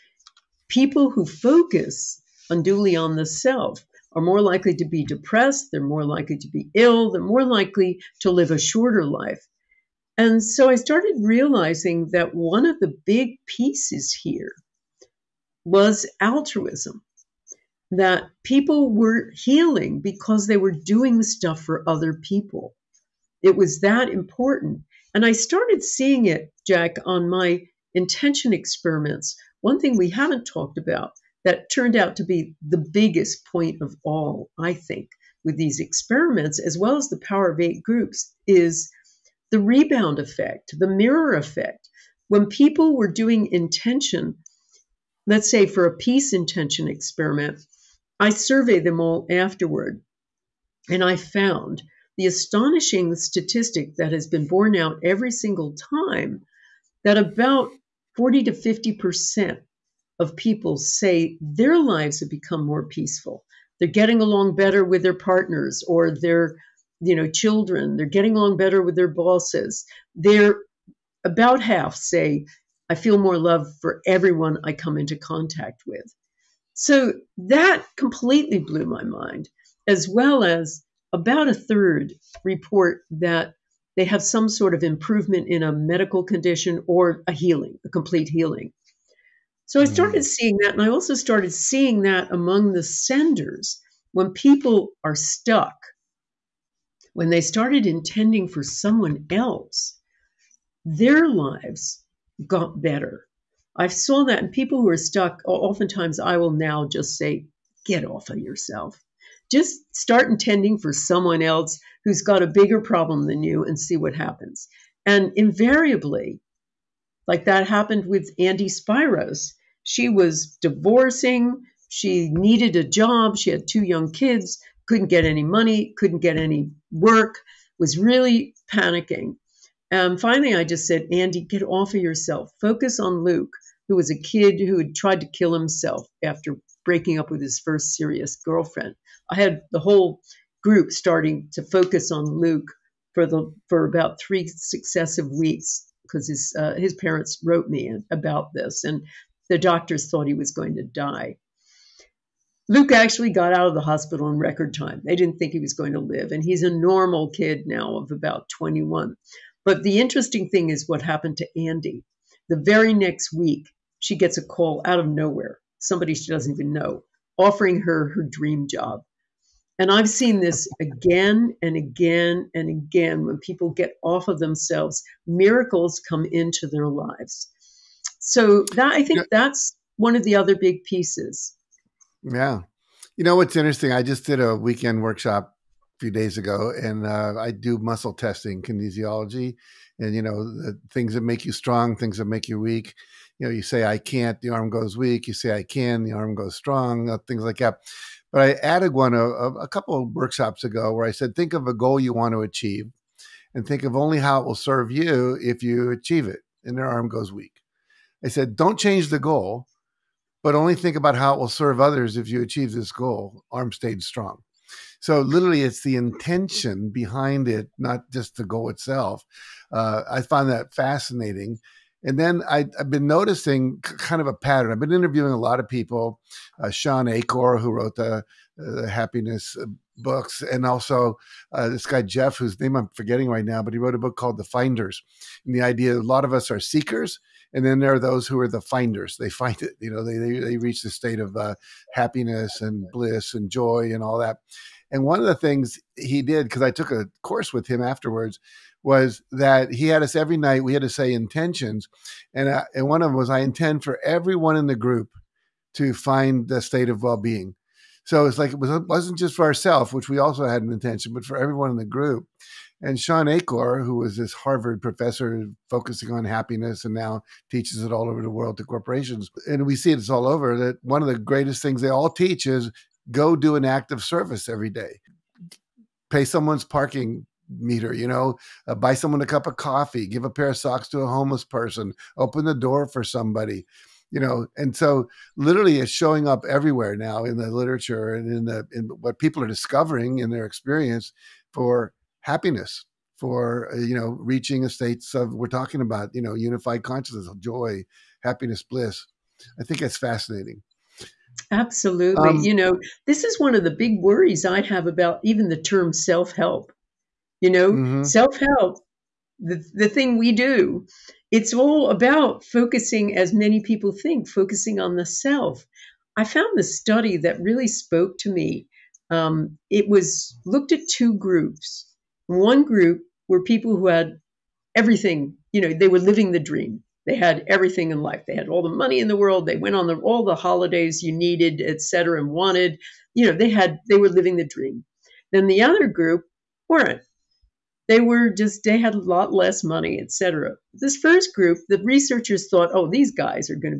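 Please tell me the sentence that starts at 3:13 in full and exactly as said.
You know, you say I can't, the arm goes weak.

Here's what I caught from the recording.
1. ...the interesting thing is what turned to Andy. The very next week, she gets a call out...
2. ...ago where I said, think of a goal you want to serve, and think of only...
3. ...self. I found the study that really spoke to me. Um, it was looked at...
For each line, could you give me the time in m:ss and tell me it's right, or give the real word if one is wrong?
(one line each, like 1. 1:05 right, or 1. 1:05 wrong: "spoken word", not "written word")
1. 2:39 wrong: "happened", not "turned"
2. 3:20 wrong: "achieve", not "serve"
3. 5:15 right.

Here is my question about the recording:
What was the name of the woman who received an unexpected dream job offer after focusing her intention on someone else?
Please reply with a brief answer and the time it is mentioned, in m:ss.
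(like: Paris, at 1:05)
Andy Spiros, at 1:58.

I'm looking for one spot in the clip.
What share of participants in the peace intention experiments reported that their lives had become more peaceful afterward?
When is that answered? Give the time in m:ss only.
0:58.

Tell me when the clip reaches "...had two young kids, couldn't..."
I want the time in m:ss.
2:03.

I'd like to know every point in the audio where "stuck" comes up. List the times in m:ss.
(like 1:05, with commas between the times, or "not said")
1:35, 1:44.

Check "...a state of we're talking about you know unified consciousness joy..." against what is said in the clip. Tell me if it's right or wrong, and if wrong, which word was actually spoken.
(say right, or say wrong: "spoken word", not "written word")
right.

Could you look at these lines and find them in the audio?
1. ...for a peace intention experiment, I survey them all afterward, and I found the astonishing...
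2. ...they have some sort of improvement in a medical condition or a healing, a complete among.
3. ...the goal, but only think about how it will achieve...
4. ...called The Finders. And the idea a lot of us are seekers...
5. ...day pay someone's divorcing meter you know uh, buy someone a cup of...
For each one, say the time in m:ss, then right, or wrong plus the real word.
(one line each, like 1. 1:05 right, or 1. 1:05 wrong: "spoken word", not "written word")
1. 0:45 right
2. 1:23 wrong: "healing", not "among"
3. 3:29 wrong: "serve", not "achieve"
4. 3:54 right
5. 4:34 wrong: "parking", not "divorcing".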